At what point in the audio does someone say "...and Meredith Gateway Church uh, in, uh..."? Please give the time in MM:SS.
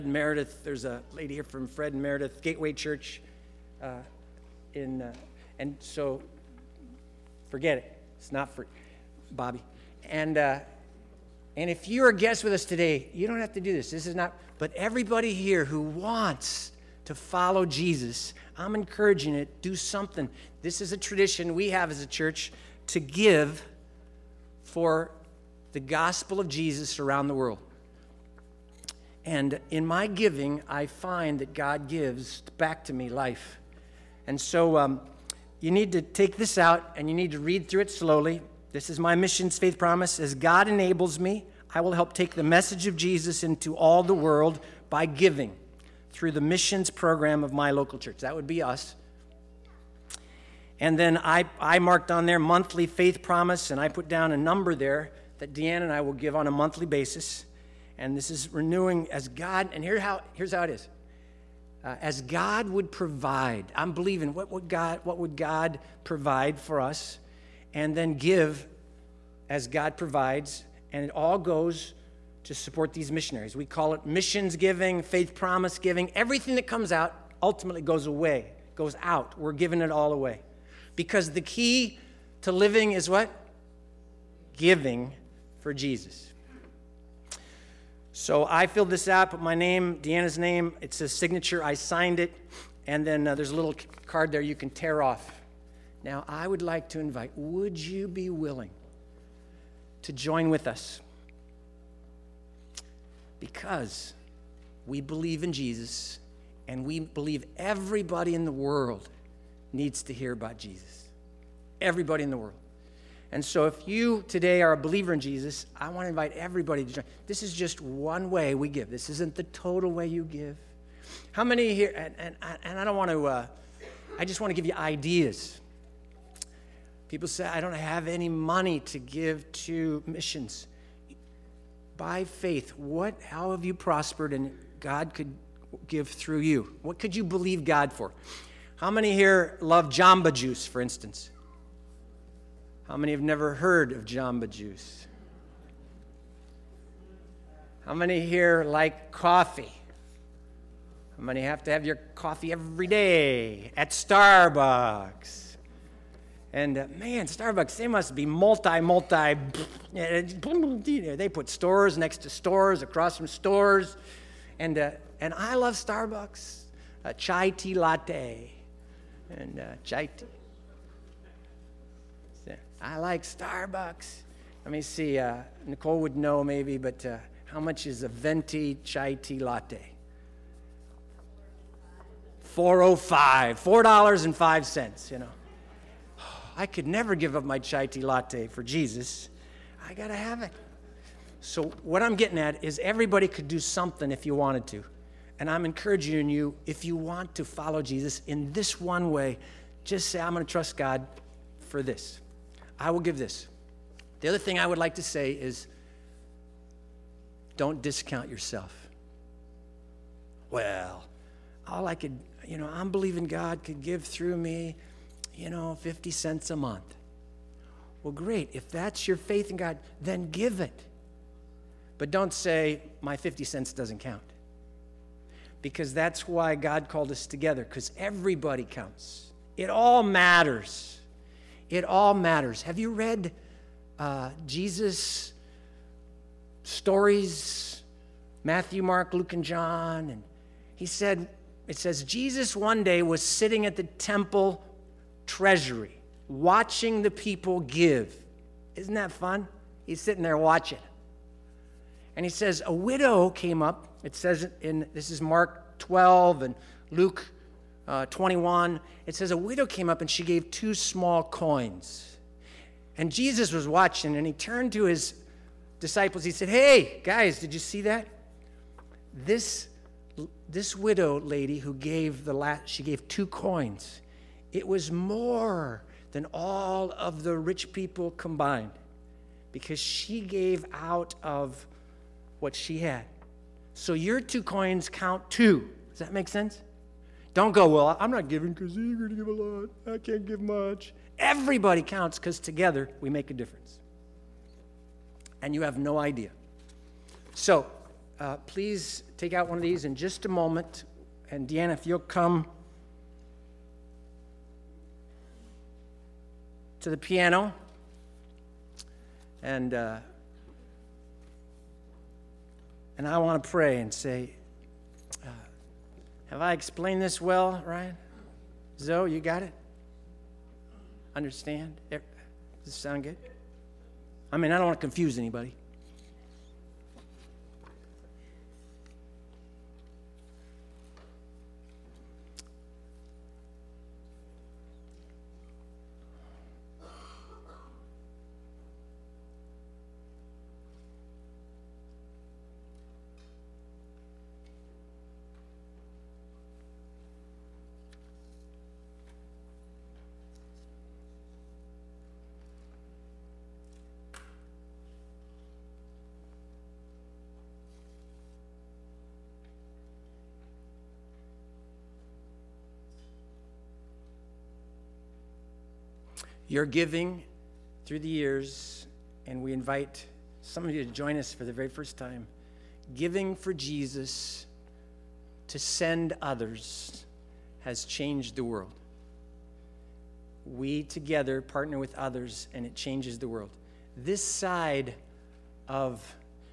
00:01.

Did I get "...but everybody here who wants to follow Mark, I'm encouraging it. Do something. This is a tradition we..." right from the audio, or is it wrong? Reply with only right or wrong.
wrong.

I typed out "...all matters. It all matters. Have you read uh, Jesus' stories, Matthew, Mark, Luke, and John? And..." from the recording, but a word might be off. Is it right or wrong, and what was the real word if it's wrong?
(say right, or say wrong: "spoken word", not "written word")
right.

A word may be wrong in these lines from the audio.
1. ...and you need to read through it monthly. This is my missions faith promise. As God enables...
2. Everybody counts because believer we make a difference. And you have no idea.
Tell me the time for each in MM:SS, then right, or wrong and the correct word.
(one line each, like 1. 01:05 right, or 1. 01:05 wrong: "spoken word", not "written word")
1. 00:36 wrong: "slowly", not "monthly"
2. 04:51 wrong: "together", not "believer".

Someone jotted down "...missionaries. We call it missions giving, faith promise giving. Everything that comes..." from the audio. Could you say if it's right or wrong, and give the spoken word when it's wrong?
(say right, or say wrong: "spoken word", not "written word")
right.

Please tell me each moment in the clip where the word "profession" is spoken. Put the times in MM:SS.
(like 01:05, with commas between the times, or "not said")
not said.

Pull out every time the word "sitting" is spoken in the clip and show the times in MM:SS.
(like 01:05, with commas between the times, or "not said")
04:03, 04:10.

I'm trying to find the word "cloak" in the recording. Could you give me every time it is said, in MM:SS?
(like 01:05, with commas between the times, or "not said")
not said.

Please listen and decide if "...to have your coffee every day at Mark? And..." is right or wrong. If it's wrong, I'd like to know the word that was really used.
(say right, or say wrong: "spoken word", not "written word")
wrong: "Starbucks", not "Mark".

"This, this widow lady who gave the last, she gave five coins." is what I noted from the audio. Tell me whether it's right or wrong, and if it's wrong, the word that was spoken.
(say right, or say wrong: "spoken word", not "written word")
wrong: "two", not "five".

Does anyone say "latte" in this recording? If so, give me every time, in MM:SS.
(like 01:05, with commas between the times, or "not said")
02:47, 02:59, 03:08.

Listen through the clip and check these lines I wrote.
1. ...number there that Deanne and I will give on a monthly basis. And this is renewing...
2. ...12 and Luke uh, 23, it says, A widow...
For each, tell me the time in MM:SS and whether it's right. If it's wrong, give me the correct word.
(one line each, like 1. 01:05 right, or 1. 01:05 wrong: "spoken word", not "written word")
1. 00:54 right
2. 04:15 wrong: "21", not "23".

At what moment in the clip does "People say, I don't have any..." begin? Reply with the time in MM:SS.
02:07.